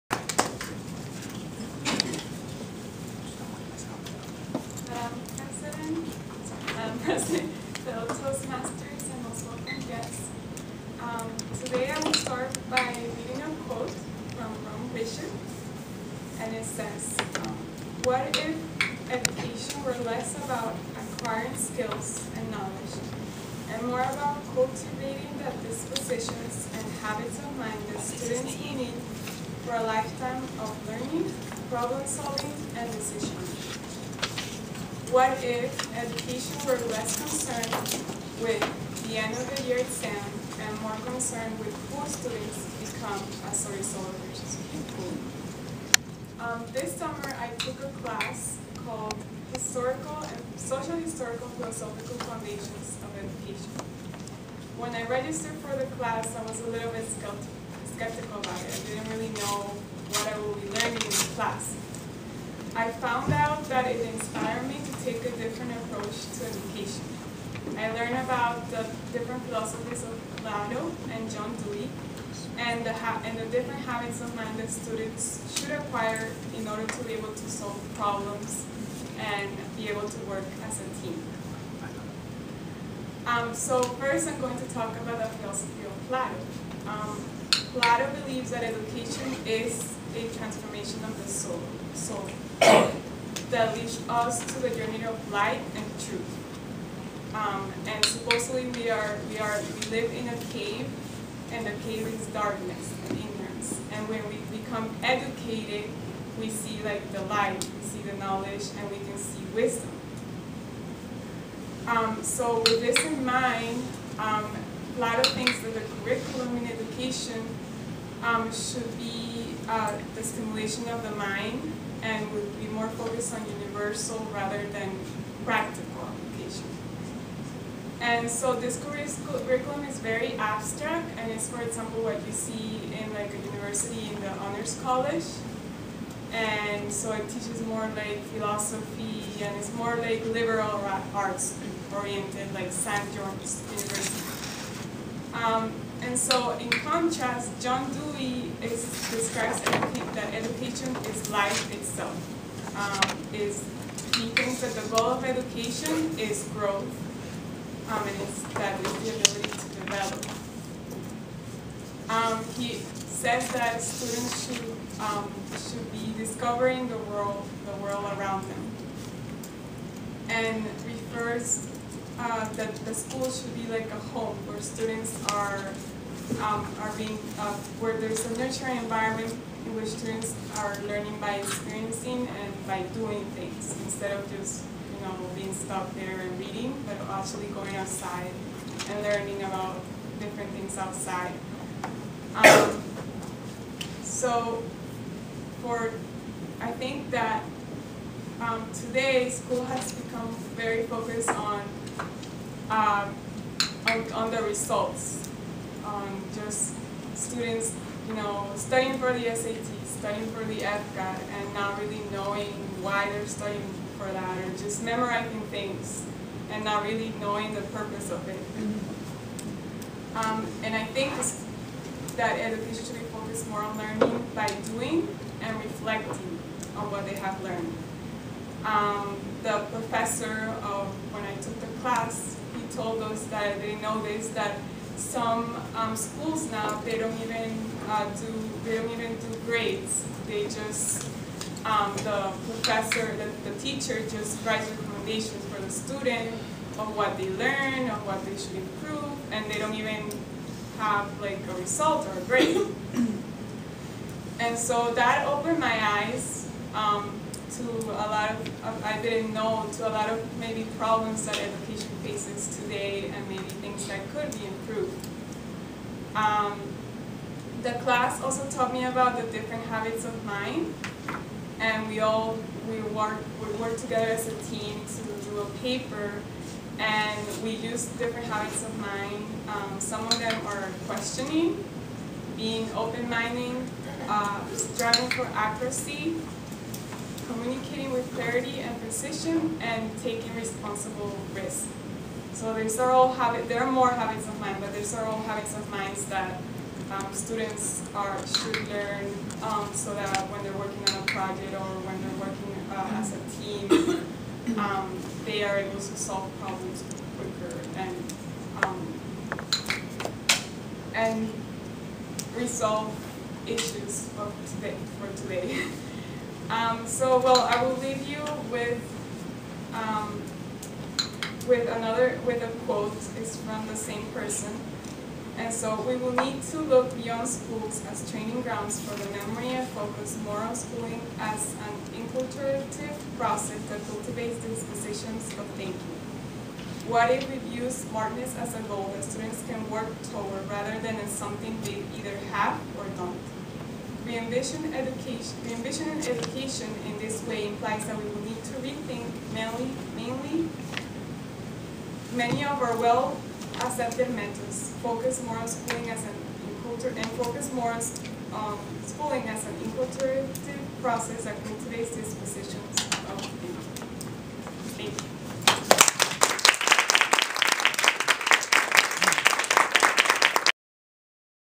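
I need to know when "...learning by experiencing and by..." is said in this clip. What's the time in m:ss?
3:00.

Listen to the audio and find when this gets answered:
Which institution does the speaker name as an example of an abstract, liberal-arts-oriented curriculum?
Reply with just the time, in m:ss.
2:22.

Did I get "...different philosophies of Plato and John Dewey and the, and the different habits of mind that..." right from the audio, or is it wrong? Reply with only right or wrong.
right.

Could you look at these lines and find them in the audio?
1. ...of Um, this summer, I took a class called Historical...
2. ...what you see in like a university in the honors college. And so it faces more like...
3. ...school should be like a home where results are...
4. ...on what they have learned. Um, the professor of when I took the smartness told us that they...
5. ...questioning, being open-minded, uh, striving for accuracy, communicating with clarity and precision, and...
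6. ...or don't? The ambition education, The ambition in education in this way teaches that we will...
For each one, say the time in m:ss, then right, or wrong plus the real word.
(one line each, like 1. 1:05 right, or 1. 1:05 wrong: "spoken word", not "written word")
1. 0:44 right
2. 2:12 wrong: "teaches", not "faces"
3. 2:52 wrong: "students", not "results"
4. 3:46 wrong: "class", not "smartness"
5. 4:40 right
6. 5:42 wrong: "implies", not "teaches".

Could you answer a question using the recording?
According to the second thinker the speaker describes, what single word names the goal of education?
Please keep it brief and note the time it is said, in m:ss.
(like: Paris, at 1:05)
Growth, at 2:36.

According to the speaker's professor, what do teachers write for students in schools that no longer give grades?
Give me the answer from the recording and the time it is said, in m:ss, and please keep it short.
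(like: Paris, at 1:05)
Recommendations, at 4:04.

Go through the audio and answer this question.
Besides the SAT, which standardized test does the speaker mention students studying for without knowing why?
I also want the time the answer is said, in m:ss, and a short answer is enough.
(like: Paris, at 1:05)
FCAT, at 3:30.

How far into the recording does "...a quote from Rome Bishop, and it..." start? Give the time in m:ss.
0:13.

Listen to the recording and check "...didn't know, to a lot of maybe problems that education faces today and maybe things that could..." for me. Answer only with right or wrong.
right.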